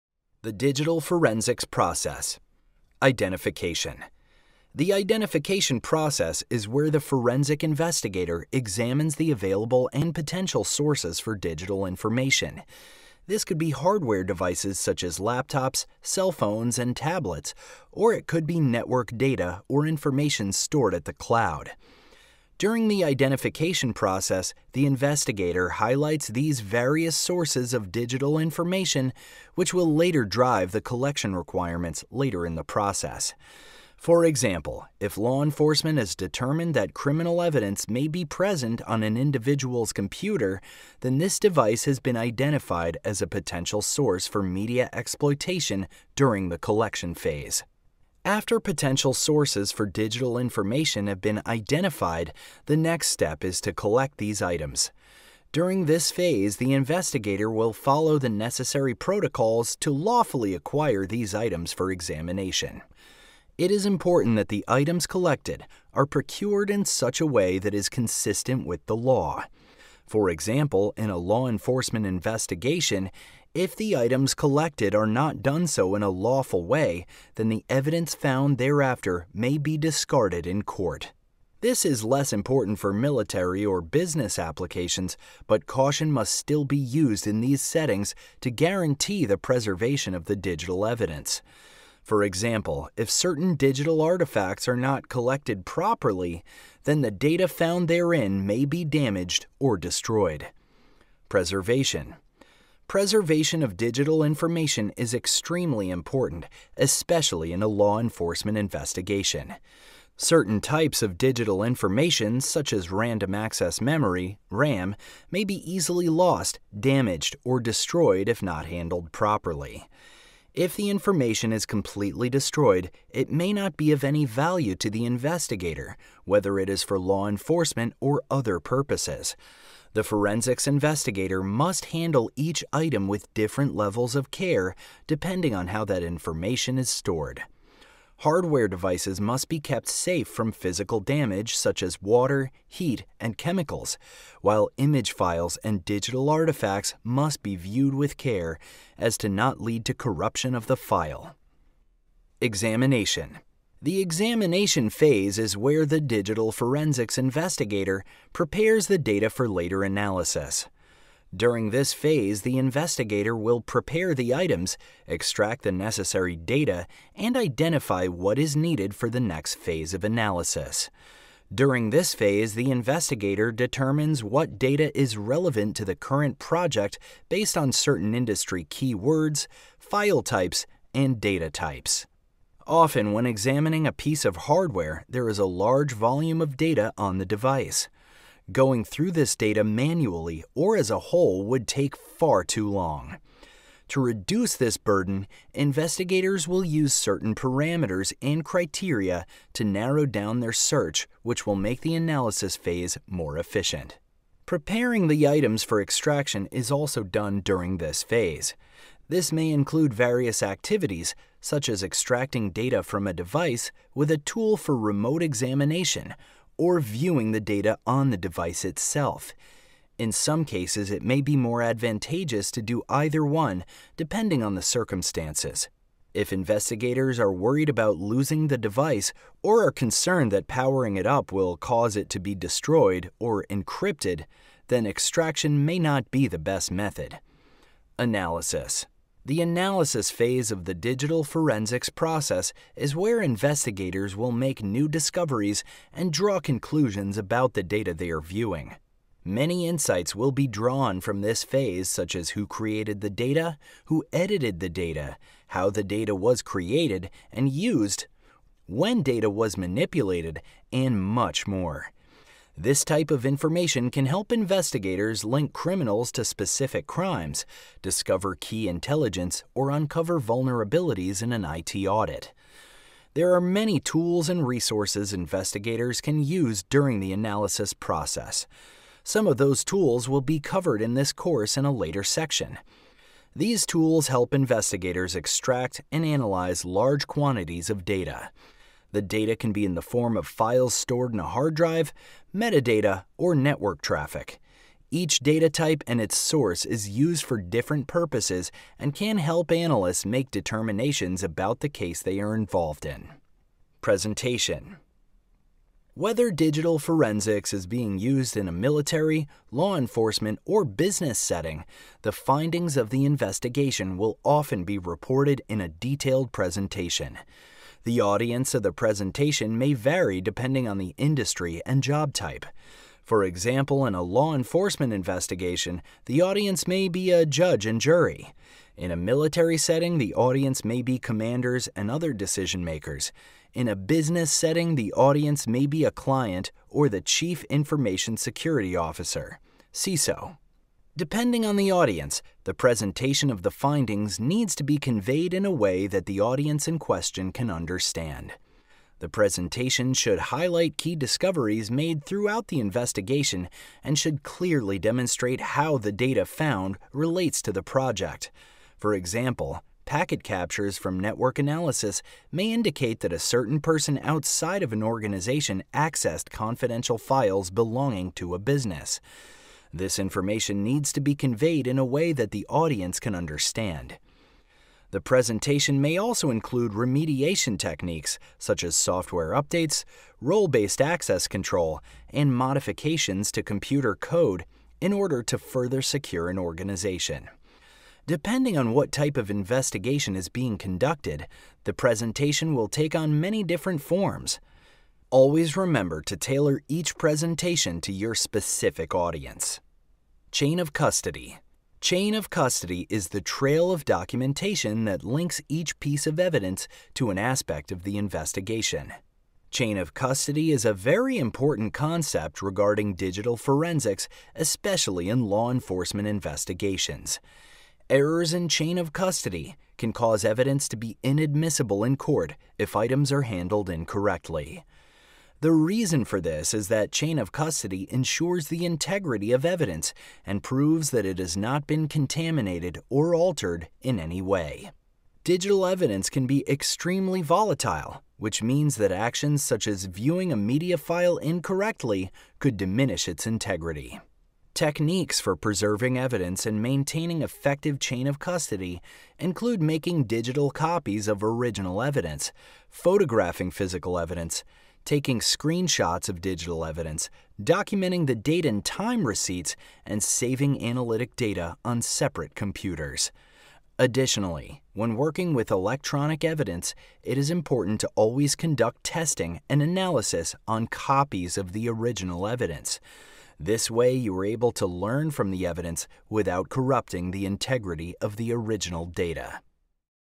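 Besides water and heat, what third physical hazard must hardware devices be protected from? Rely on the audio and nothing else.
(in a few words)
Chemicals.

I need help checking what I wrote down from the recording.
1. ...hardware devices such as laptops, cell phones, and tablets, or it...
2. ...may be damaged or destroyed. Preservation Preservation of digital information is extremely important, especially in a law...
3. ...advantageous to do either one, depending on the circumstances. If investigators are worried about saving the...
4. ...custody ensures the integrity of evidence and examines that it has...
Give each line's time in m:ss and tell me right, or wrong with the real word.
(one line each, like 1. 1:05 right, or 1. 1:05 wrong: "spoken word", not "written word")
1. 0:13 right
2. 1:38 right
3. 3:41 wrong: "losing", not "saving"
4. 7:07 wrong: "proves", not "examines".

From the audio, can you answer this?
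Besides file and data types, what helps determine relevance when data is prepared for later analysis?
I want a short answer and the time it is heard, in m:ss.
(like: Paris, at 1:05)
Industry keywords, at 2:58.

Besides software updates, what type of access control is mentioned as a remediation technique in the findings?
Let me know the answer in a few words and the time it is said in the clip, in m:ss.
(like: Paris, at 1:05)
Role-based access control, at 6:20.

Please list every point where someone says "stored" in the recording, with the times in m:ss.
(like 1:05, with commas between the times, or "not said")
0:20, 2:16, 4:50.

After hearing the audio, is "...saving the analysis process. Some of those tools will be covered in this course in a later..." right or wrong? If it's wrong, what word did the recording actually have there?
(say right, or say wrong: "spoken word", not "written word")
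wrong: "during", not "saving".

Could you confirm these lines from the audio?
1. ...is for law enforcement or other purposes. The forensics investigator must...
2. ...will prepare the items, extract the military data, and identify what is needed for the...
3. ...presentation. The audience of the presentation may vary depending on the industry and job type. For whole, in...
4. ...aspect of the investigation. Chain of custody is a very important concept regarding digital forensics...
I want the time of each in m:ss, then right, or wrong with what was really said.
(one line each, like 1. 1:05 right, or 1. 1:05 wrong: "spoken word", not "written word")
1. 2:06 right
2. 2:43 wrong: "necessary", not "military"
3. 5:16 wrong: "example", not "whole"
4. 6:47 right.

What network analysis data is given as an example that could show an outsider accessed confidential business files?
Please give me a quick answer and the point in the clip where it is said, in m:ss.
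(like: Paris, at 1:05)
Packet captures, at 5:59.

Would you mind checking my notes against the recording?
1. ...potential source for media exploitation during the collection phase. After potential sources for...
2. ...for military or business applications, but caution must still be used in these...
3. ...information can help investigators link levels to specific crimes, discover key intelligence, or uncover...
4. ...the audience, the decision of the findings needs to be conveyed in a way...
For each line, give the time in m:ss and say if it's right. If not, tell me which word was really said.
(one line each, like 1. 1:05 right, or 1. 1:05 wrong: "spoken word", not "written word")
1. 0:43 right
2. 1:22 right
3. 4:23 wrong: "criminals", not "levels"
4. 5:41 wrong: "presentation", not "decision".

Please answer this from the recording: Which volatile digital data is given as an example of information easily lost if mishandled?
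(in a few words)
Random access memory.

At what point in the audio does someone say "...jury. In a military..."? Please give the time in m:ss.
5:27.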